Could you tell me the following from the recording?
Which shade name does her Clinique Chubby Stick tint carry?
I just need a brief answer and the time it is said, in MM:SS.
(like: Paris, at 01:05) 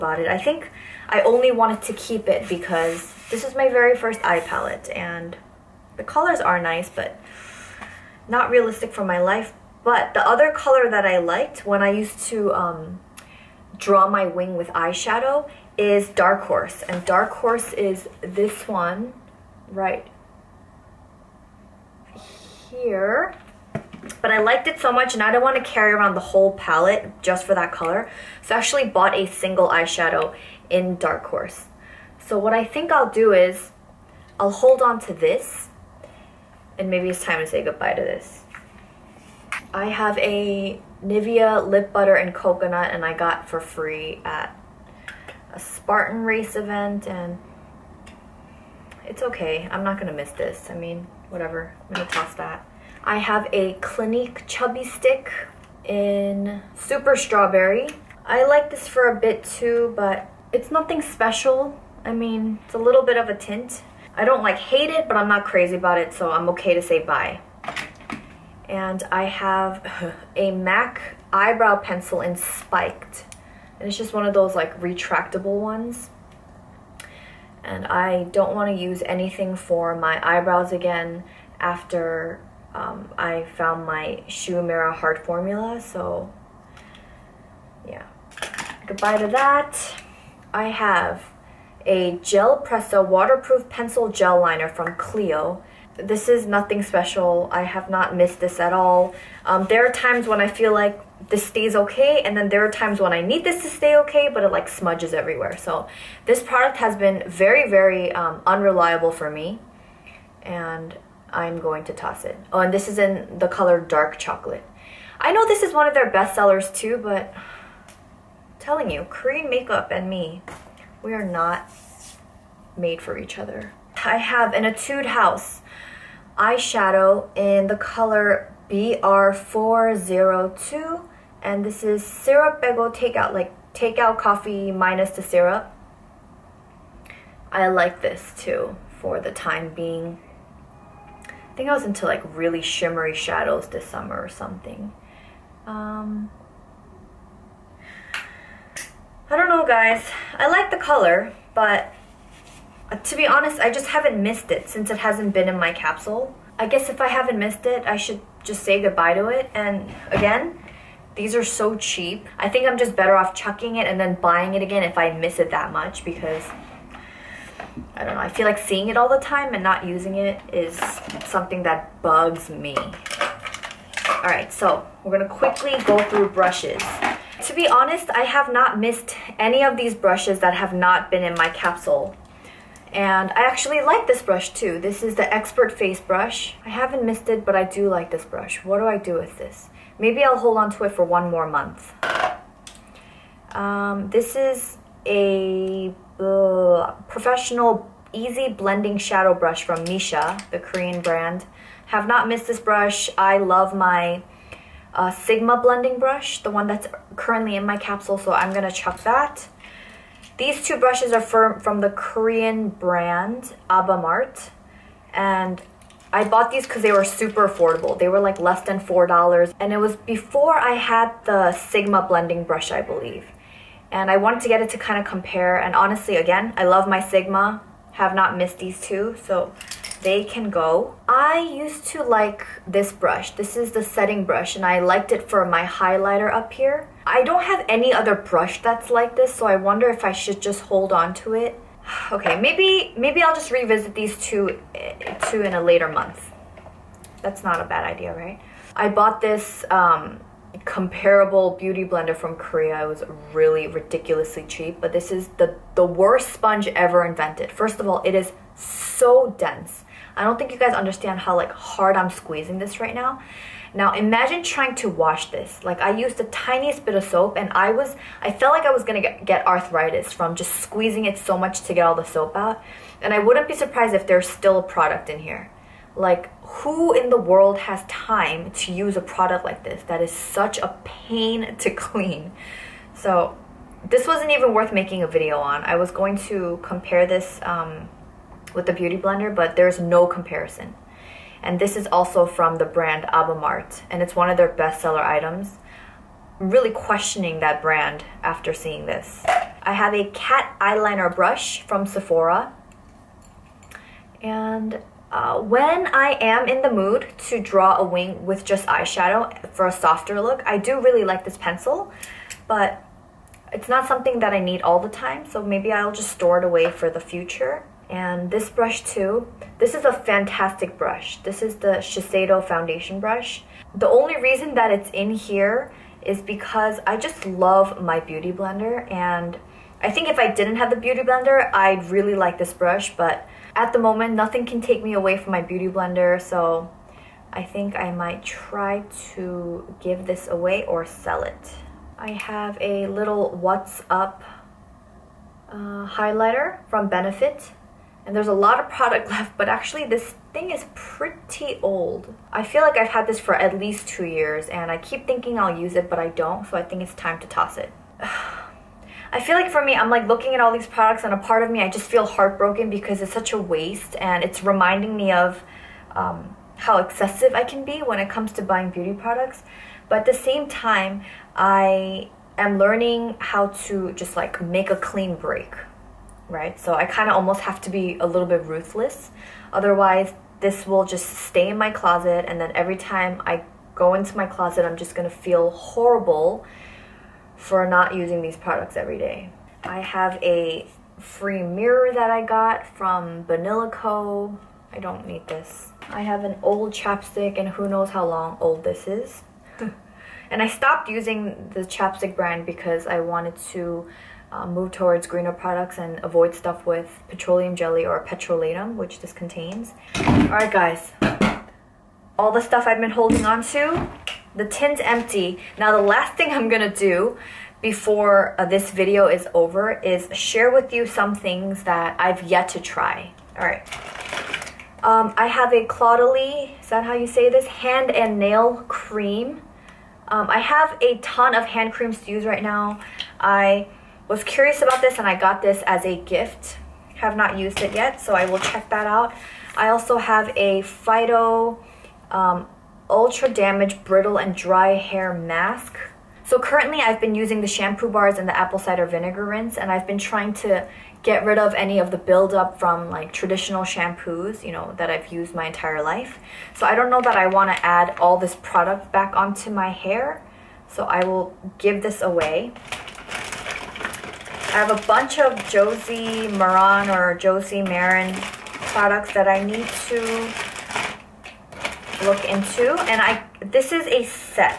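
Super Strawberry, at 00:56.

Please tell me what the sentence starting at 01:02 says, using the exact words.
I mean, it's a little bit of a tint.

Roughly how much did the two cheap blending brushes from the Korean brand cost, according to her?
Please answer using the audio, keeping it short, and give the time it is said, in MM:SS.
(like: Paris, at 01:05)
less than $4, at 03:38.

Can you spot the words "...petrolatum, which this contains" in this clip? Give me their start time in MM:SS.
06:48.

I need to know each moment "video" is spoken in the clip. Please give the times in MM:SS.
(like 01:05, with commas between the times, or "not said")
04:45, 06:58.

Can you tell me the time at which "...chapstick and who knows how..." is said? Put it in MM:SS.
06:36.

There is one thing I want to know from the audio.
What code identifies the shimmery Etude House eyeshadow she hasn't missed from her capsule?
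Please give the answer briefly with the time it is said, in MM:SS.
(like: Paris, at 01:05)
BR402, at 02:08.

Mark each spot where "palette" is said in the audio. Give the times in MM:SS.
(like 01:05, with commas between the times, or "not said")
00:04, 00:26.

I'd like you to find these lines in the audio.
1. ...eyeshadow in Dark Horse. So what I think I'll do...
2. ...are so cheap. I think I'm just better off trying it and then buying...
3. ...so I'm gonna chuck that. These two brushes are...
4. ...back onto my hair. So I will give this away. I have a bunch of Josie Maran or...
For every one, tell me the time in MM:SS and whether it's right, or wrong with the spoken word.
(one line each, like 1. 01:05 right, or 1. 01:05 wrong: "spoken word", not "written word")
1. 00:29 right
2. 02:41 wrong: "chucking", not "trying"
3. 03:28 right
4. 07:38 right.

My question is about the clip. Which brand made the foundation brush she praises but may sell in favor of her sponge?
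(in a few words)
Shiseido.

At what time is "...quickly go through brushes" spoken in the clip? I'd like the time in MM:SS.
02:55.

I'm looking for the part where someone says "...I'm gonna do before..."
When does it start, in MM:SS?
06:56.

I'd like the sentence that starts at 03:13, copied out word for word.
Um, this is a uh, professional easy blending shadow brush from Missha, the Korean brand.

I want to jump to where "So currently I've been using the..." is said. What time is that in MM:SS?
07:26.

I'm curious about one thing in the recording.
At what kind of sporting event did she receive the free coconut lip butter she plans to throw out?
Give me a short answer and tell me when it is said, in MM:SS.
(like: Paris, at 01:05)
Spartan race, at 00:45.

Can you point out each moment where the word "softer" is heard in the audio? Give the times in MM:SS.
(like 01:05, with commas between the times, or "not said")
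05:09.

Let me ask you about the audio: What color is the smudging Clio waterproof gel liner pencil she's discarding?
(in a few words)
dark chocolate.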